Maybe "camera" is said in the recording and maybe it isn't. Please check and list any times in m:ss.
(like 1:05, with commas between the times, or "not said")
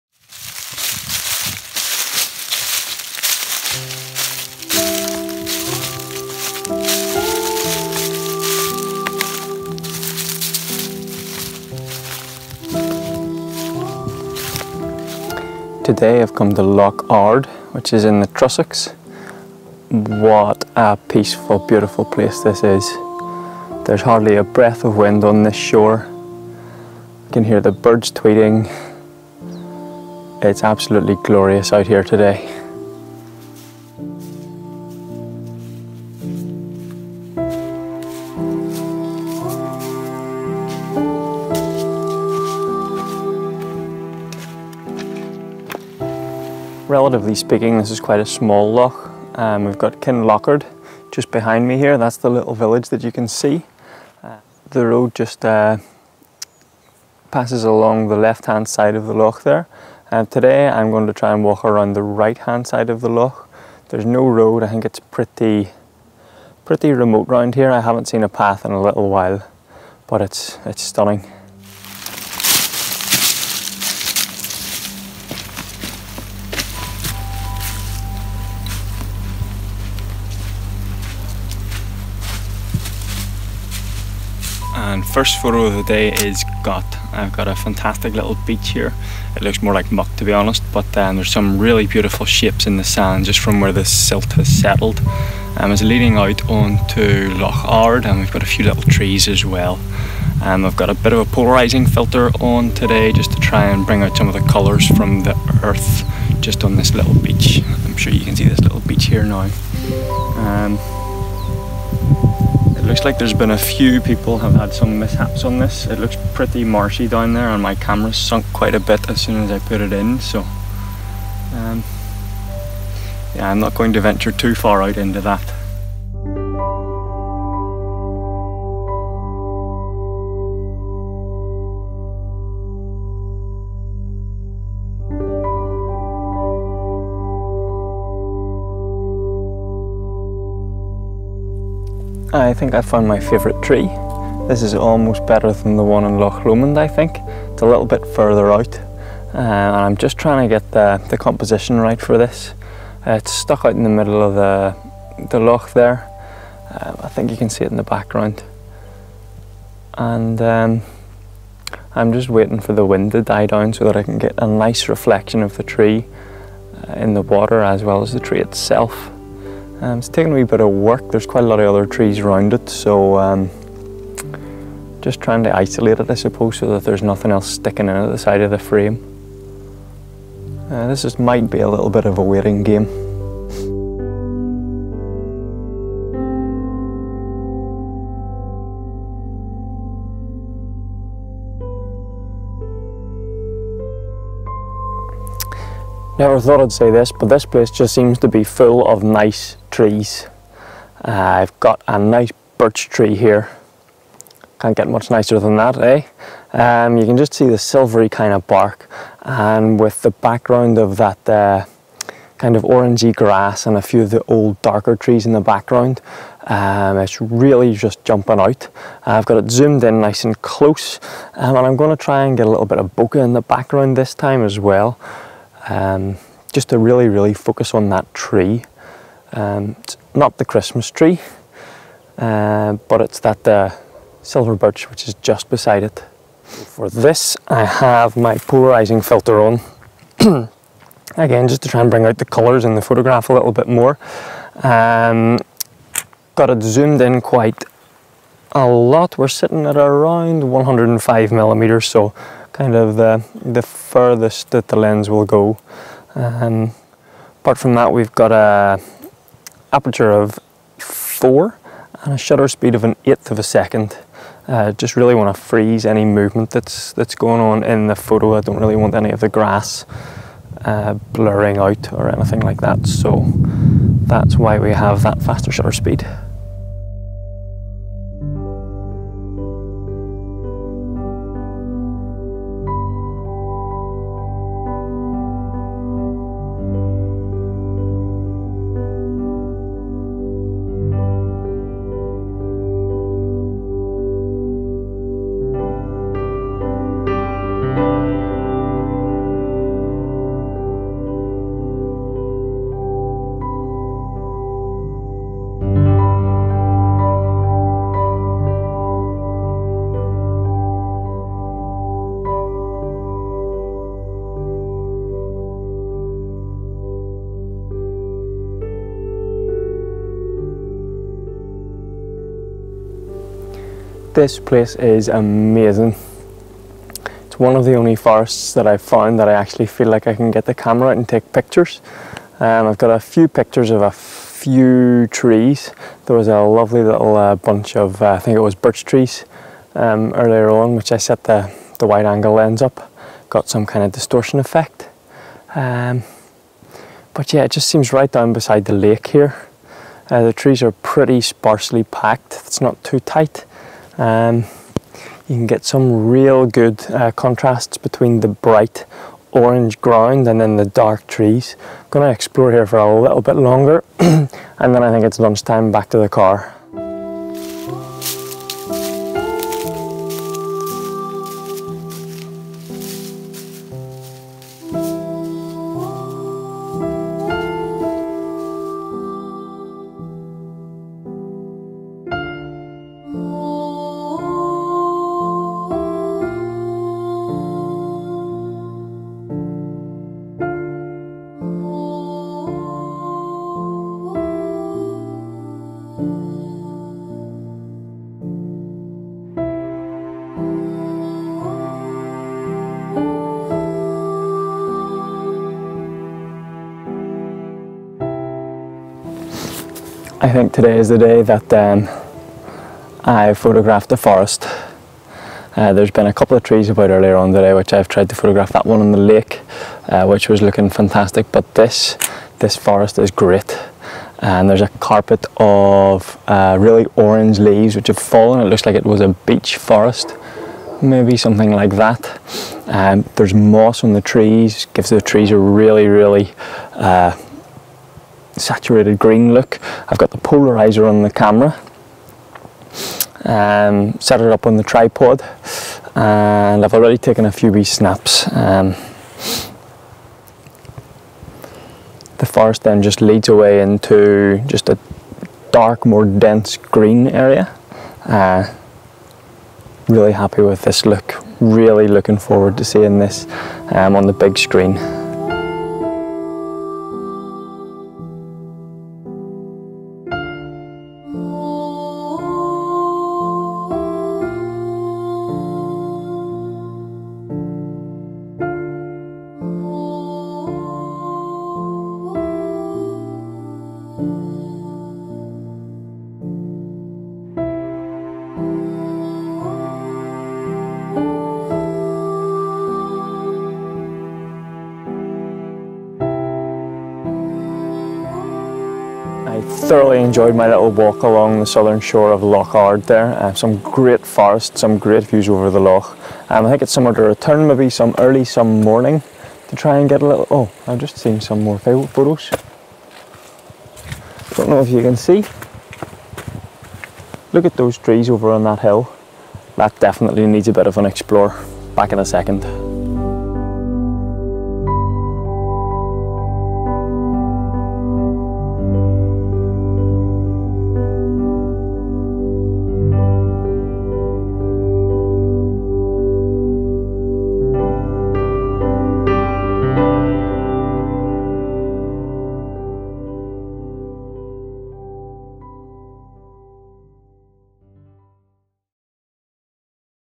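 1:57, 5:30, 7:21.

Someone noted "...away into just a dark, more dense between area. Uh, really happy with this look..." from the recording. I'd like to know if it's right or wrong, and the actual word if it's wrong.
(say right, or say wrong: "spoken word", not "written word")
wrong: "green", not "between".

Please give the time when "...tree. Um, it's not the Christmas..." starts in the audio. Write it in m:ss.
3:48.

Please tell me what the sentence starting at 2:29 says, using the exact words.
Uh, and I'm just trying to get the, the composition right for this.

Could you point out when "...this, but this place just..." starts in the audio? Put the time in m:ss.
3:16.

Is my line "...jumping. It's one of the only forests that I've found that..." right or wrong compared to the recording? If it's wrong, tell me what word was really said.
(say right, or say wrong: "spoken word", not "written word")
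wrong: "amazing", not "jumping".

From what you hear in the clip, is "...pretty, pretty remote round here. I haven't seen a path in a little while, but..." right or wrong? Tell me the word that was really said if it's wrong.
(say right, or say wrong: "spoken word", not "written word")
right.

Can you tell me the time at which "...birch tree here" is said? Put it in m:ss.
3:22.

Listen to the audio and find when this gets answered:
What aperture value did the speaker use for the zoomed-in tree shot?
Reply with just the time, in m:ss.
4:20.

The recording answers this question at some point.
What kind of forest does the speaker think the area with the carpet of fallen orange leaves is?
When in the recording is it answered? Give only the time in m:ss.
7:09.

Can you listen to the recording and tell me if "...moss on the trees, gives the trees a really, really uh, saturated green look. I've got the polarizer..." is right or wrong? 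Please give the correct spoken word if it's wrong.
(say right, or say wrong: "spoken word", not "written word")
right.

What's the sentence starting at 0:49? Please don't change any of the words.
Um, we've got Kinlochard just behind me here.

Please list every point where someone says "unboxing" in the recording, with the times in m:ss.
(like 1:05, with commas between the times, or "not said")
not said.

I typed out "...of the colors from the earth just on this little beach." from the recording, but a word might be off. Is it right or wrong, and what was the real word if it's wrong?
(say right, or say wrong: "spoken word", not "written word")
right.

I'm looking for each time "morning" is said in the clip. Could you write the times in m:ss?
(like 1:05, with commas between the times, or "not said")
8:28.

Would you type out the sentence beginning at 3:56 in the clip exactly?
For this I have my polarizing filter on.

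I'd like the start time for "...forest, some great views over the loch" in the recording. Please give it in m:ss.
8:24.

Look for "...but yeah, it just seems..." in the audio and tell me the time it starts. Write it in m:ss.
5:47.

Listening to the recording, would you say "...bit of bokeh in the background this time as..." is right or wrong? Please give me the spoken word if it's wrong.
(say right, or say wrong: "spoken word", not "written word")
right.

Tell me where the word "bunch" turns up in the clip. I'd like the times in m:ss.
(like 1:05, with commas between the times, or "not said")
5:37.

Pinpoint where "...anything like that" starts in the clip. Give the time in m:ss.
4:32.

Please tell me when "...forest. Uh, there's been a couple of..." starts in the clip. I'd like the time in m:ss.
6:53.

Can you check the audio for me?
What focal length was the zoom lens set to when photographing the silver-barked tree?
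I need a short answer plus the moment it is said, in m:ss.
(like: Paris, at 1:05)
105 millimeters, at 4:10.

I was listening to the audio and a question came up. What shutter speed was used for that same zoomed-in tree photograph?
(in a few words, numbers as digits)
1/8 second.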